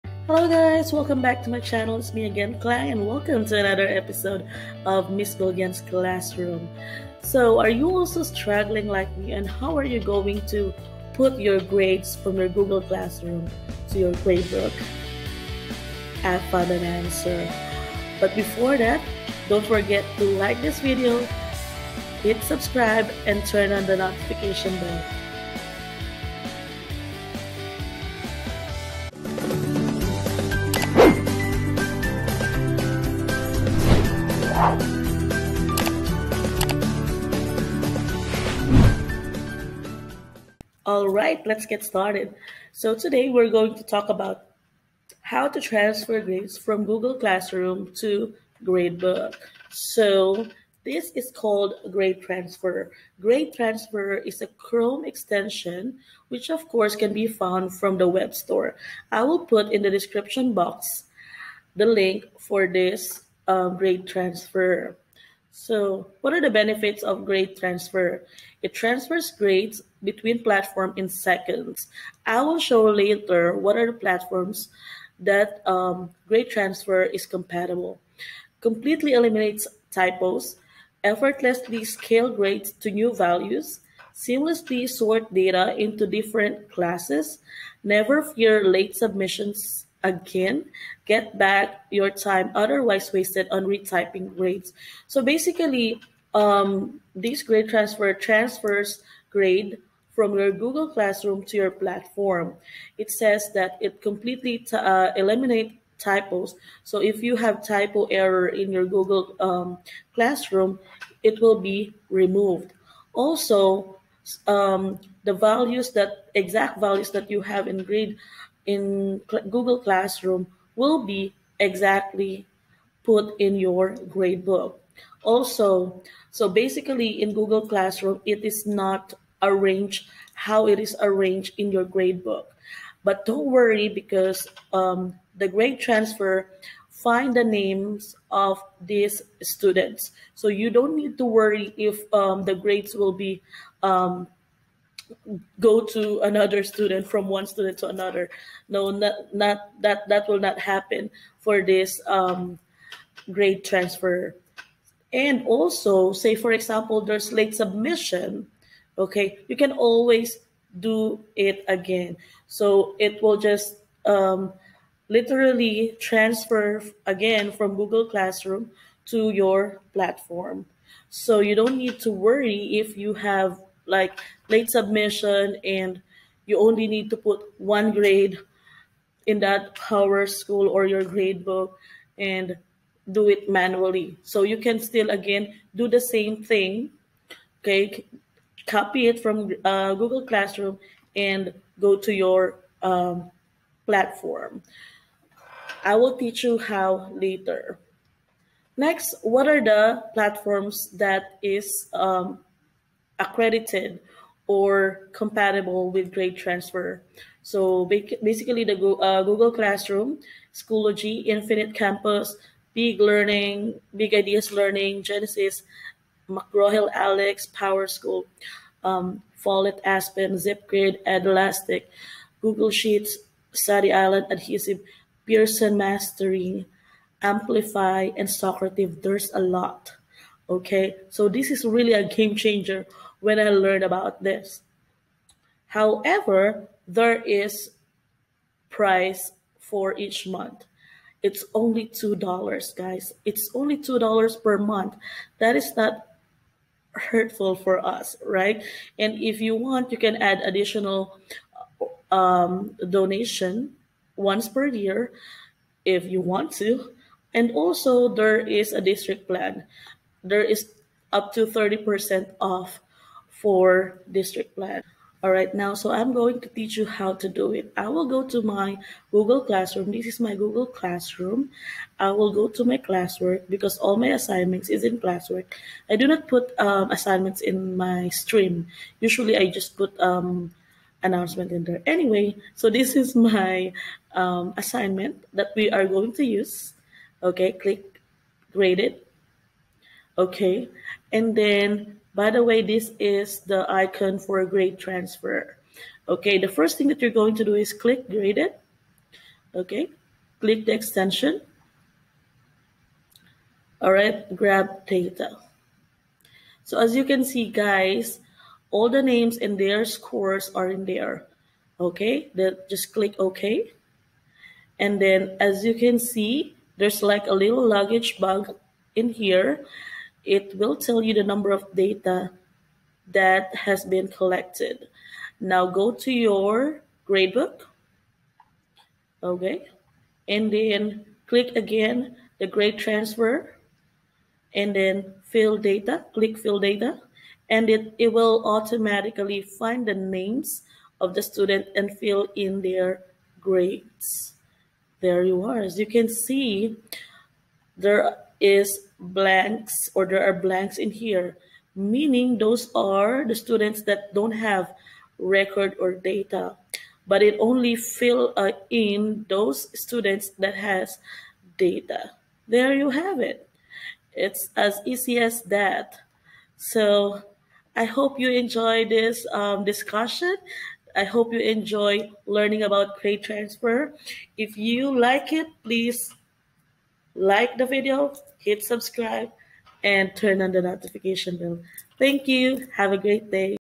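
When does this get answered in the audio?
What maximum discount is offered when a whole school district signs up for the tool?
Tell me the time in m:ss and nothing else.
4:21.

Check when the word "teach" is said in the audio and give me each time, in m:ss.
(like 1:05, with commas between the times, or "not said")
3:16, 4:26.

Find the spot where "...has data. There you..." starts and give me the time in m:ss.
6:00.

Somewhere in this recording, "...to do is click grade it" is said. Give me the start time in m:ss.
4:57.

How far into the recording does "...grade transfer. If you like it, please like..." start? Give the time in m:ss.
6:12.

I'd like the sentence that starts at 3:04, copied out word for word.
So you can still, again, do the same thing, okay?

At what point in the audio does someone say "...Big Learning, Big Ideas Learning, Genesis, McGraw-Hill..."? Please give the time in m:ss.
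3:32.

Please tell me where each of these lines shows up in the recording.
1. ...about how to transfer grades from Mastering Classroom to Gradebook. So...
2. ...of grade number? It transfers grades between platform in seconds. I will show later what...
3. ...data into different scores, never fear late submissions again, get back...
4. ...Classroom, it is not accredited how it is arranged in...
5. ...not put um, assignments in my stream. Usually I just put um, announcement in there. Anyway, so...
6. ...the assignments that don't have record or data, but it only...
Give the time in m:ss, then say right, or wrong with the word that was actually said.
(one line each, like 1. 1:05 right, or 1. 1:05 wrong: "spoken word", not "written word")
1. 0:44 wrong: "Google", not "Mastering"
2. 1:07 wrong: "transfer", not "number"
3. 1:25 wrong: "classes", not "scores"
4. 2:07 wrong: "arranged", not "accredited"
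5. 4:36 right
6. 5:53 wrong: "students", not "assignments".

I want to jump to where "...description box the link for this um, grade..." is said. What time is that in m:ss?
0:59.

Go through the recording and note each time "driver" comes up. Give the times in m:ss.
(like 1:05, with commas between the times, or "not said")
not said.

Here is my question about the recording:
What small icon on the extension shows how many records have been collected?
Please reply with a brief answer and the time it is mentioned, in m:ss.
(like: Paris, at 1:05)
Luggage bag, at 5:17.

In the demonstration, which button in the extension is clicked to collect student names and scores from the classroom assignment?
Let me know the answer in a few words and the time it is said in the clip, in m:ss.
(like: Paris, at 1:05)
Grab data, at 5:04.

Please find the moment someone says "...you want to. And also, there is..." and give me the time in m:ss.
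4:16.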